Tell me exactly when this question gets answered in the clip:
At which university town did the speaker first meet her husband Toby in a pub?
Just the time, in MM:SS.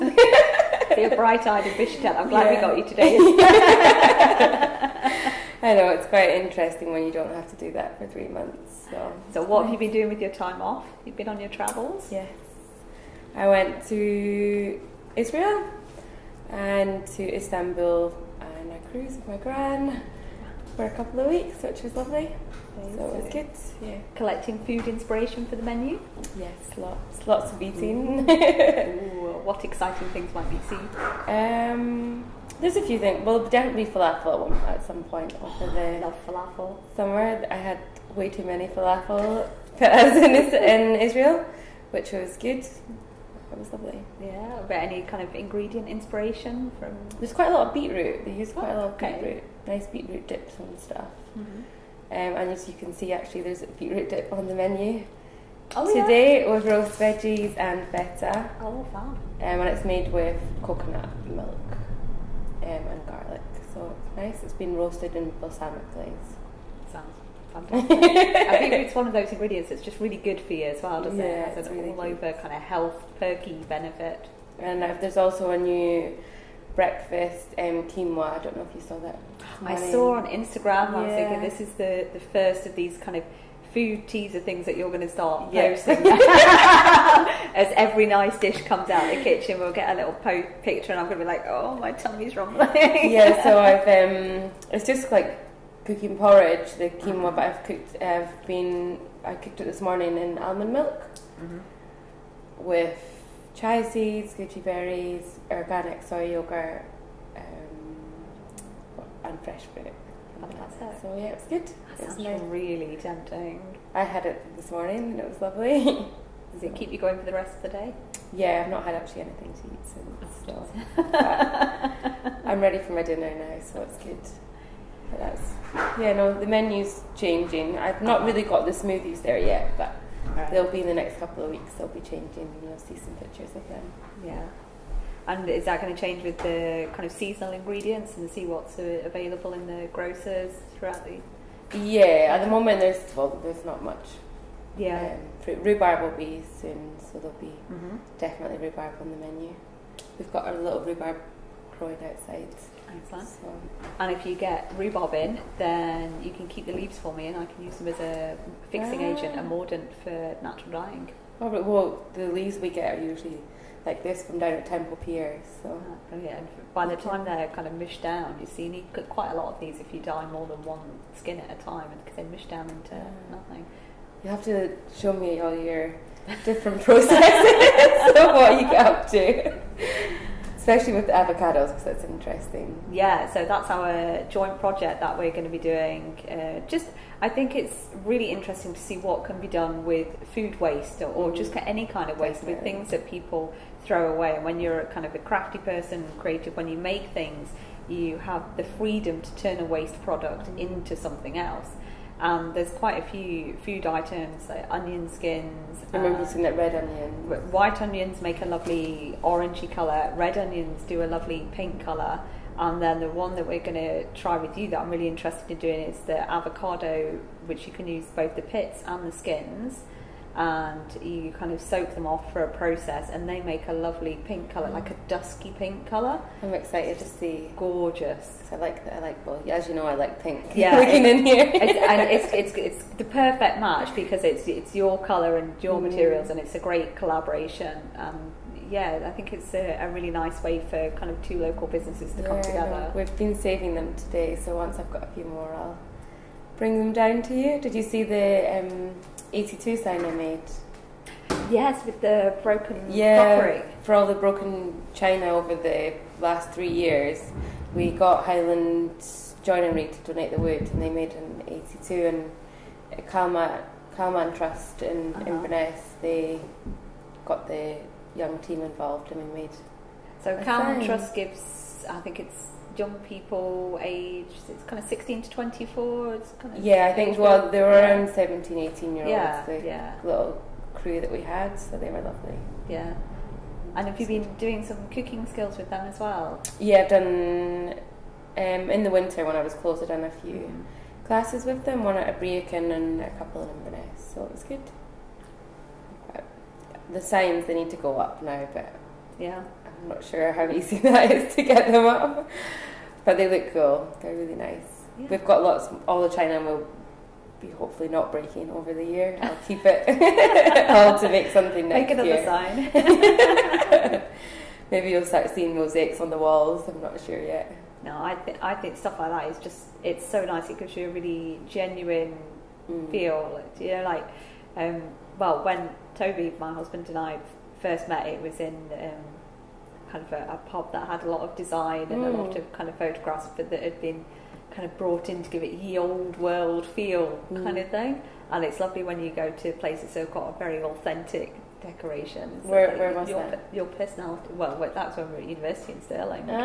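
05:45.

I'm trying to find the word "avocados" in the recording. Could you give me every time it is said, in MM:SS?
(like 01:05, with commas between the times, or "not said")
03:01, 03:36.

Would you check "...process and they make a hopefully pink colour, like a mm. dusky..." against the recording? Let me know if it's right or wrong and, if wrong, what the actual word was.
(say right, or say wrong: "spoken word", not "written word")
wrong: "lovely", not "hopefully".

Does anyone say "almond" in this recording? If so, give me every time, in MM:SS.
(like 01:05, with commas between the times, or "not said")
01:40.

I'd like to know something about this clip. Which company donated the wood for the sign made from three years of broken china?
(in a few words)
Highland Joinery.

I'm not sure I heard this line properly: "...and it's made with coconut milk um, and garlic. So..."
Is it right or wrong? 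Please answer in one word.
right.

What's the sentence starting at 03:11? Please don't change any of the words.
just any kind of waste Definitely.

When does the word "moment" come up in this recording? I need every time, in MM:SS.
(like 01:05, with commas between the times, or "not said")
02:22.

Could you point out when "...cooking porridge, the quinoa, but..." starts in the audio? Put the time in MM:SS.
01:35.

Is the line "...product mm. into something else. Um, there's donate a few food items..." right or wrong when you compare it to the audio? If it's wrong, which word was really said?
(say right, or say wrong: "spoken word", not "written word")
wrong: "quite", not "donate".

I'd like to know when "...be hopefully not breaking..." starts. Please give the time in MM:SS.
05:07.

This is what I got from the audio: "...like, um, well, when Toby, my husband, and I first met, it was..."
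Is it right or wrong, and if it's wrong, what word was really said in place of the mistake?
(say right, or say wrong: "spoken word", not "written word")
right.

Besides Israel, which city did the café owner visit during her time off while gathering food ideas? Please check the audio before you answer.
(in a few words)
Istanbul.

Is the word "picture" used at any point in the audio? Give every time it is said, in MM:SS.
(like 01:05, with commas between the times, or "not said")
01:30, 02:13.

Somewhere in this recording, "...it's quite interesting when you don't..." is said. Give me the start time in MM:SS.
00:05.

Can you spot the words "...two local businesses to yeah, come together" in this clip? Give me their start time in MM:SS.
04:01.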